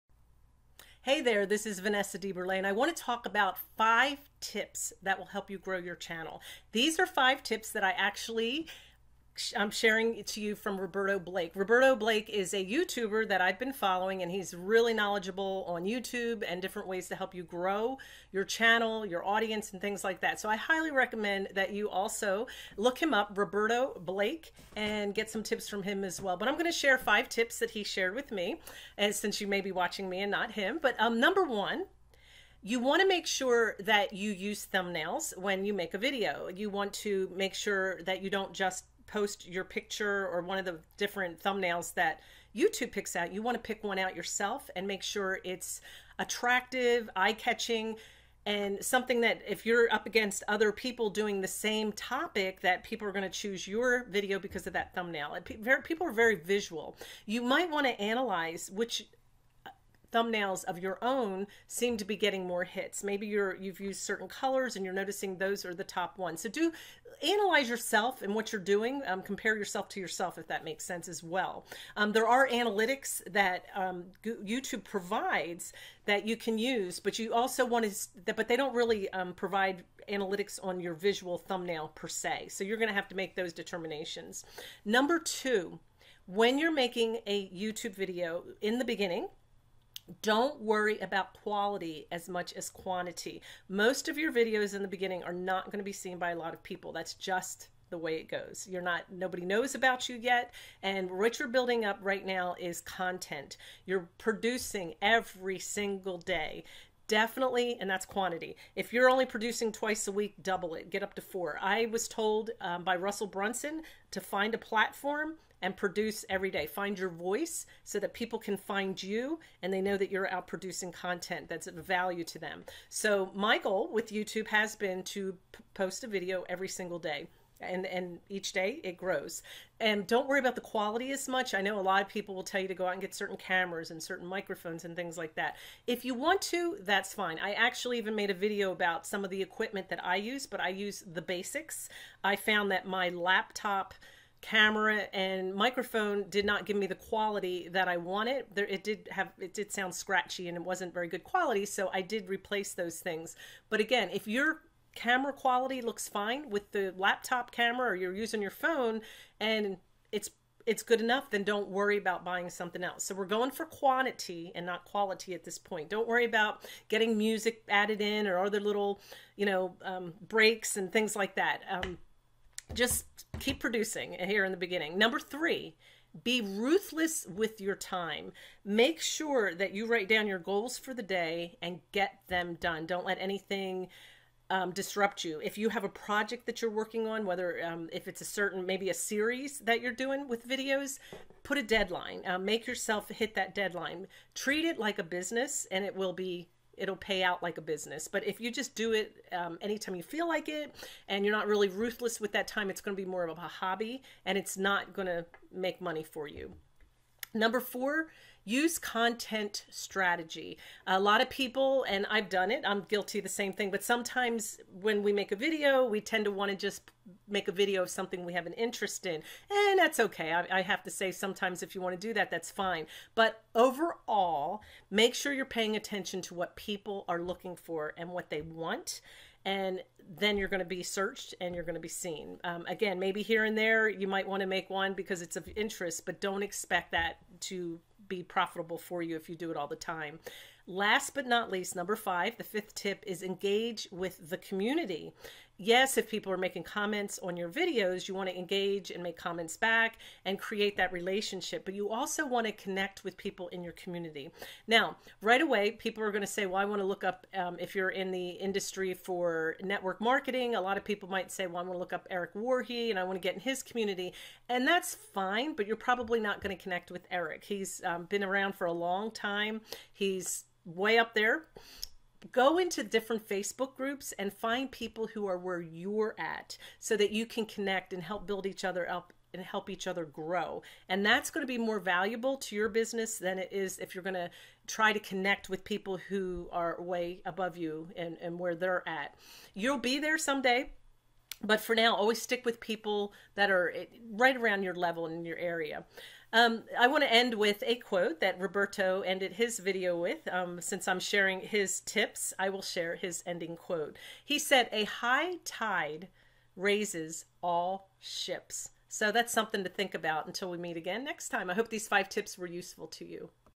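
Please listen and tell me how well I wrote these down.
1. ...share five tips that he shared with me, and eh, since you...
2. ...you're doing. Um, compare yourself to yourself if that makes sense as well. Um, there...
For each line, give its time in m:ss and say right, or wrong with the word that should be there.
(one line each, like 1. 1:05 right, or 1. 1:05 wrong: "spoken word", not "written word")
1. 0:26 right
2. 1:08 right.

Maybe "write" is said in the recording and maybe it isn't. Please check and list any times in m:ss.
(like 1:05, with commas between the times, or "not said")
2:59.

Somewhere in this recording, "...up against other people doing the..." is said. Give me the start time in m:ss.
0:49.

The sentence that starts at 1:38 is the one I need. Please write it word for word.
You're not, nobody knows about you yet.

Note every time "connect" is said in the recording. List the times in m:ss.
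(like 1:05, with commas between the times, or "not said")
4:12, 4:26, 4:37, 4:44.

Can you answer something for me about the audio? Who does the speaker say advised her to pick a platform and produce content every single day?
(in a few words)
Russell Brunson.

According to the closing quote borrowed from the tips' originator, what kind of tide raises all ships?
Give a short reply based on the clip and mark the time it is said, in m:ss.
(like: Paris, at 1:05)
A high tide, at 5:04.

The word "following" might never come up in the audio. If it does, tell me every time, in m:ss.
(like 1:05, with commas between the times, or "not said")
0:13.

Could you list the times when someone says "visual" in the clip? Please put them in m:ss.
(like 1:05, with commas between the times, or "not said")
0:56, 1:20.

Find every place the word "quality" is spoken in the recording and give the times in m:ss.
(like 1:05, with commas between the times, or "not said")
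1:31, 2:10, 2:26, 2:31, 2:35, 2:44.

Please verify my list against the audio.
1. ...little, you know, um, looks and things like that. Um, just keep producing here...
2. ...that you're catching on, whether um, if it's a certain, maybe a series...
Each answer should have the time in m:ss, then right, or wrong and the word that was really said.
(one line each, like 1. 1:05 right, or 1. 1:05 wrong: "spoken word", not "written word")
1. 2:48 wrong: "breaks", not "looks"
2. 3:06 wrong: "working", not "catching".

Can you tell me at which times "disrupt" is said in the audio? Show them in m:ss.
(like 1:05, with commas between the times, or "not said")
3:04.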